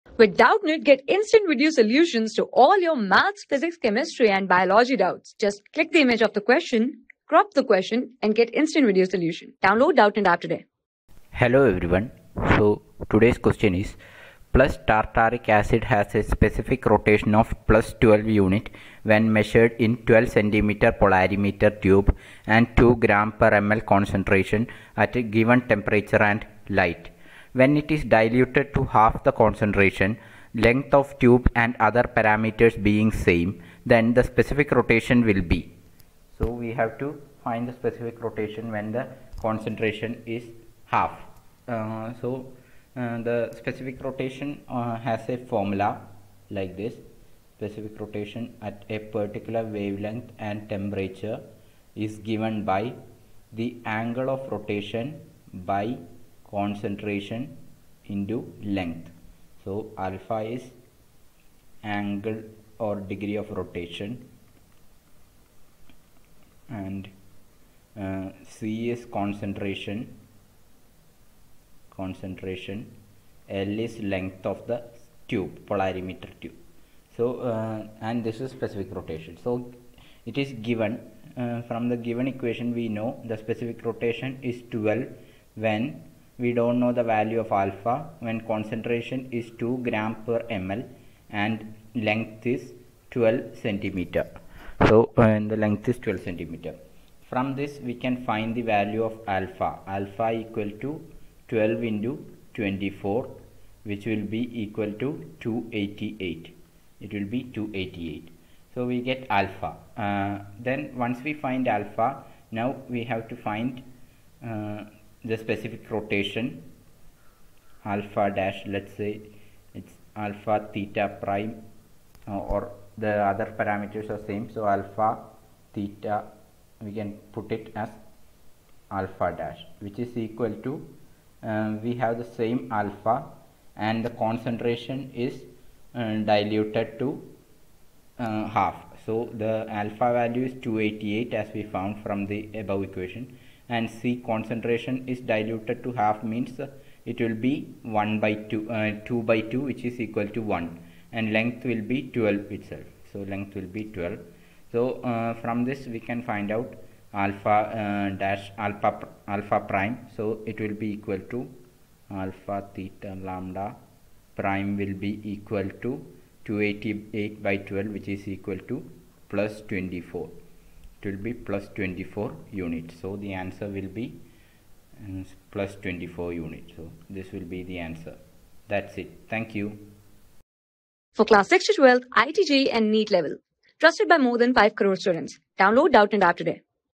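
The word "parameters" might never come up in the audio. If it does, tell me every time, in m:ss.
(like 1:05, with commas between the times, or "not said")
0:32, 2:03.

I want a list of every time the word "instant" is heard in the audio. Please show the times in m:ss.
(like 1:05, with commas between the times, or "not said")
0:01, 0:08.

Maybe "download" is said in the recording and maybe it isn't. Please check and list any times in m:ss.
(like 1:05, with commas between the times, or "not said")
0:09, 3:05.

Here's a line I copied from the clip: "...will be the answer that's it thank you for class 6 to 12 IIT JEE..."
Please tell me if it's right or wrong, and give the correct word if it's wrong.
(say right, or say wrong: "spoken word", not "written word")
right.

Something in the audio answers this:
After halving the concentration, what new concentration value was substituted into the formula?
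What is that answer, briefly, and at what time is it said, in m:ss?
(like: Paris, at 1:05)
1, at 2:29.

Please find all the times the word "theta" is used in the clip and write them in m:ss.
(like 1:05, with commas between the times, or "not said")
2:00, 2:05, 2:42.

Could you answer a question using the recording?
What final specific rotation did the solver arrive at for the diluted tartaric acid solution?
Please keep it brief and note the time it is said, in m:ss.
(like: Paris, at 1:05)
+24 units, at 2:51.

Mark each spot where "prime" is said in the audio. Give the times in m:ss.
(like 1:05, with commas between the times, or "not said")
2:01, 2:39, 2:44.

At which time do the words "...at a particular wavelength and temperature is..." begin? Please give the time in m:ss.
0:48.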